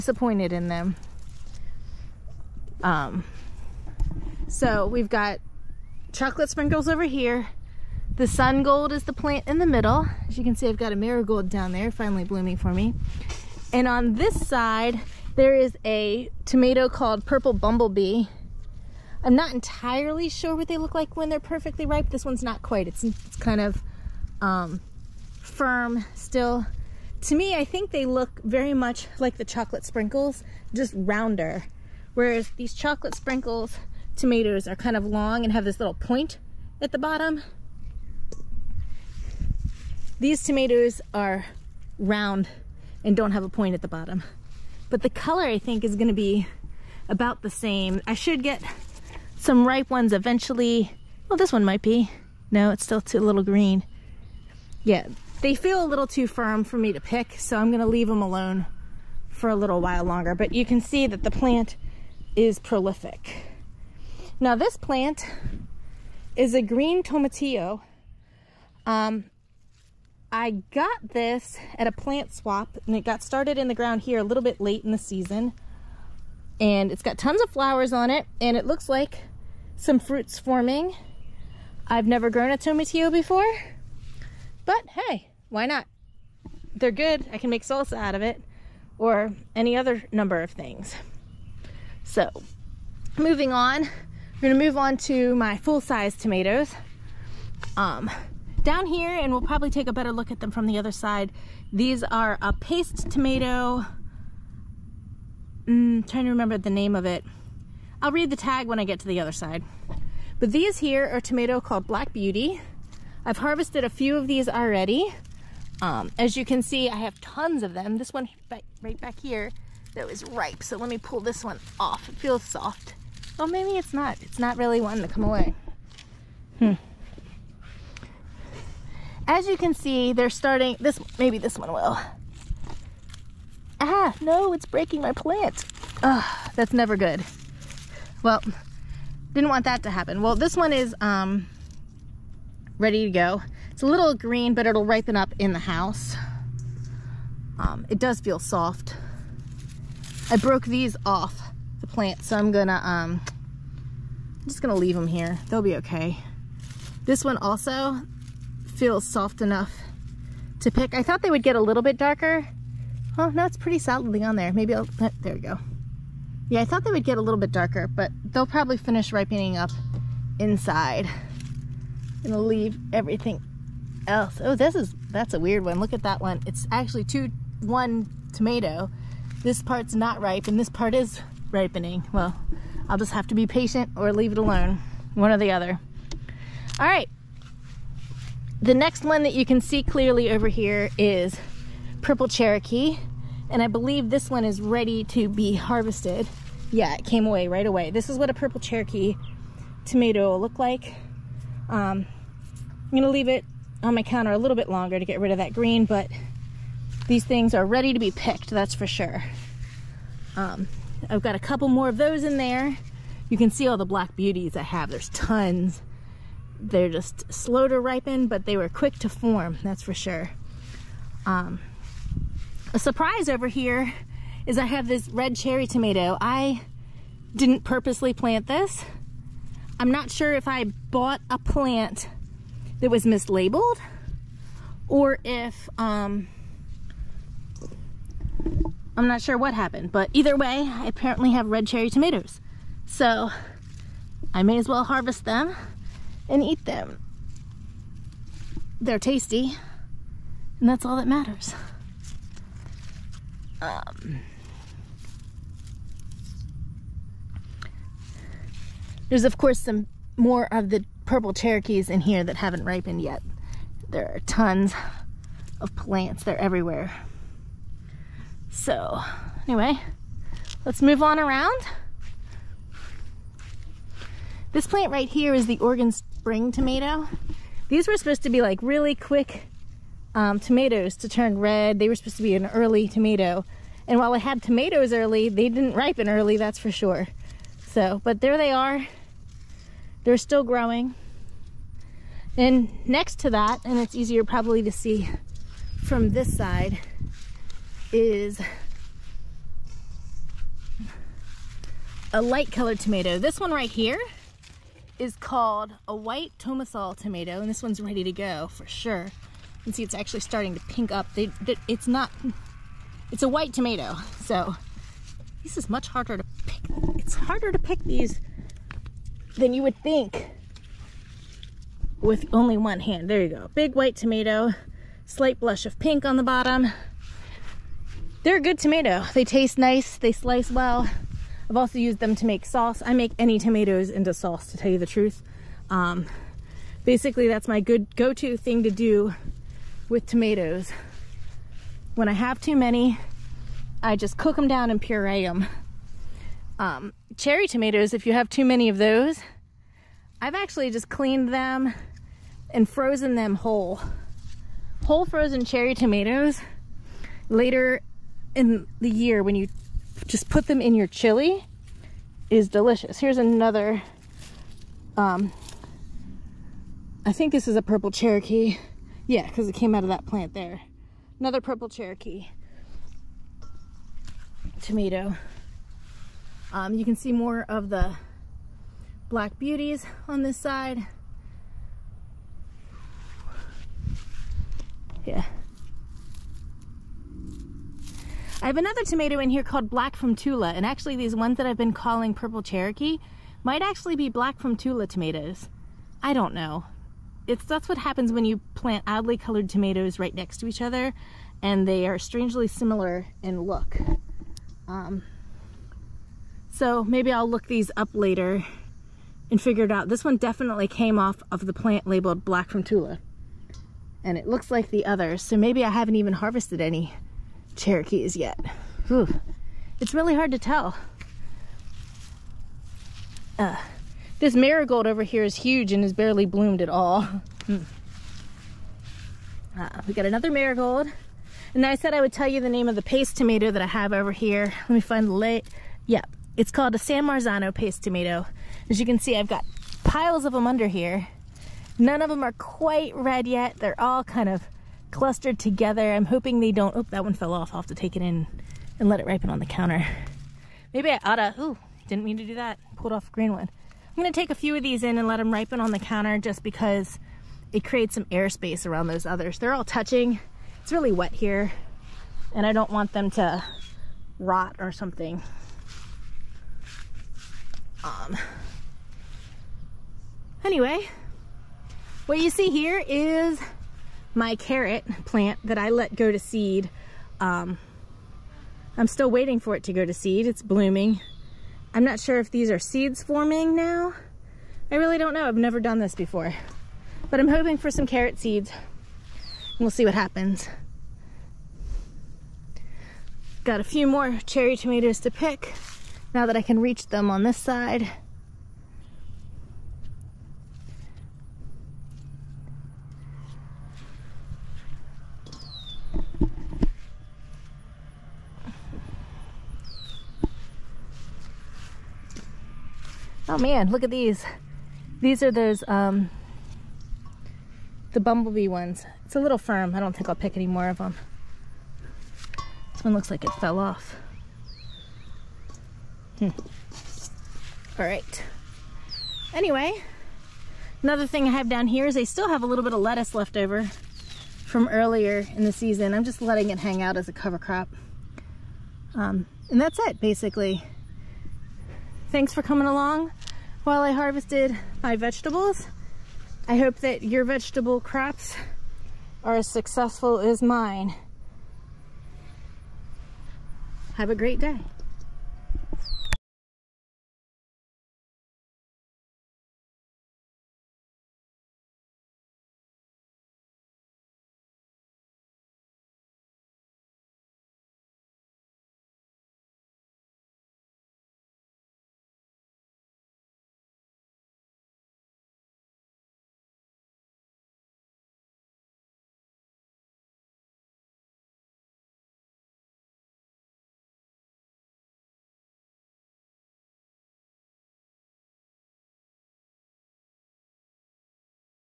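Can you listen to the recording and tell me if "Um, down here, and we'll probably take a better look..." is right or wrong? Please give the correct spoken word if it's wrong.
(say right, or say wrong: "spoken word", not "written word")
right.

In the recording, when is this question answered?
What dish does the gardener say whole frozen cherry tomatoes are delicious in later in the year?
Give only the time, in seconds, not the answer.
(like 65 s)
360 s.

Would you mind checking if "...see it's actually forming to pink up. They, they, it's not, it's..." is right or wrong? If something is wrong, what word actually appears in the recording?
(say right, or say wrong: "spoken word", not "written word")
wrong: "starting", not "forming".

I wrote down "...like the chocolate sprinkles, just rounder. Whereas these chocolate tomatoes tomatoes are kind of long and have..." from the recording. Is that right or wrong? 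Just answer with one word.
wrong.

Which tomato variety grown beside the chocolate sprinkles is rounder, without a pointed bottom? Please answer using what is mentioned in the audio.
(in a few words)
Purple Bumblebee.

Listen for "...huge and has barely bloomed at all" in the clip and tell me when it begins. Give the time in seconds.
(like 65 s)
425 s.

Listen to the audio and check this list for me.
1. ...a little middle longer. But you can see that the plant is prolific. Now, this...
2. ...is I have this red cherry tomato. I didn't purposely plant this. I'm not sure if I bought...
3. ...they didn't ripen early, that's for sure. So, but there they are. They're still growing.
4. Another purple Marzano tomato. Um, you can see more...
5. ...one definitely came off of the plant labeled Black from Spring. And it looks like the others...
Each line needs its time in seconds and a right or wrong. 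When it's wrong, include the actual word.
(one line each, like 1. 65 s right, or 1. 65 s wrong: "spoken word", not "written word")
1. 59 s wrong: "while", not "middle"
2. 224 s right
3. 285 s right
4. 371 s wrong: "Cherokee", not "Marzano"
5. 410 s wrong: "Tula", not "Spring".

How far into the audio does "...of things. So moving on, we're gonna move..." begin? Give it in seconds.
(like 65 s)
90 s.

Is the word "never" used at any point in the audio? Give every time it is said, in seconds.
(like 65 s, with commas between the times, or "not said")
82 s, 136 s, 485 s.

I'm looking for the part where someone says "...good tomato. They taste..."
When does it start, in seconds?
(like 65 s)
328 s.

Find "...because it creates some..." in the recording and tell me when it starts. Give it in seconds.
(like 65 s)
456 s.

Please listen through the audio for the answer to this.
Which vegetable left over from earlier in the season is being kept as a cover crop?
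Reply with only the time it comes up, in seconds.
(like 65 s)
532 s.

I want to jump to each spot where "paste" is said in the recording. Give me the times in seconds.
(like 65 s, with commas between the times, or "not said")
102 s, 432 s, 437 s.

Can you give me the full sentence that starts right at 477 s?
Um, I'm still waiting for it to go to seed.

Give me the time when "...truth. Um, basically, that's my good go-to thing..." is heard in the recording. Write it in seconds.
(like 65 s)
334 s.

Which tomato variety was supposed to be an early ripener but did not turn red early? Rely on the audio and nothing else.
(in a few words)
Oregon Spring.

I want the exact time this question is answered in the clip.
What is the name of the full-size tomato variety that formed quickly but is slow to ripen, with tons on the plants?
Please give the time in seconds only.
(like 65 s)
111 s.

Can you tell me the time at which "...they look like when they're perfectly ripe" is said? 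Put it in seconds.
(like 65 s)
20 s.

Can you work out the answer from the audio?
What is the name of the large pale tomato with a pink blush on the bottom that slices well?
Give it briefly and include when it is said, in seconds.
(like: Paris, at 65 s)
White Tomesol, at 305 s.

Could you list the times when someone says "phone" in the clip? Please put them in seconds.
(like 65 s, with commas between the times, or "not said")
not said.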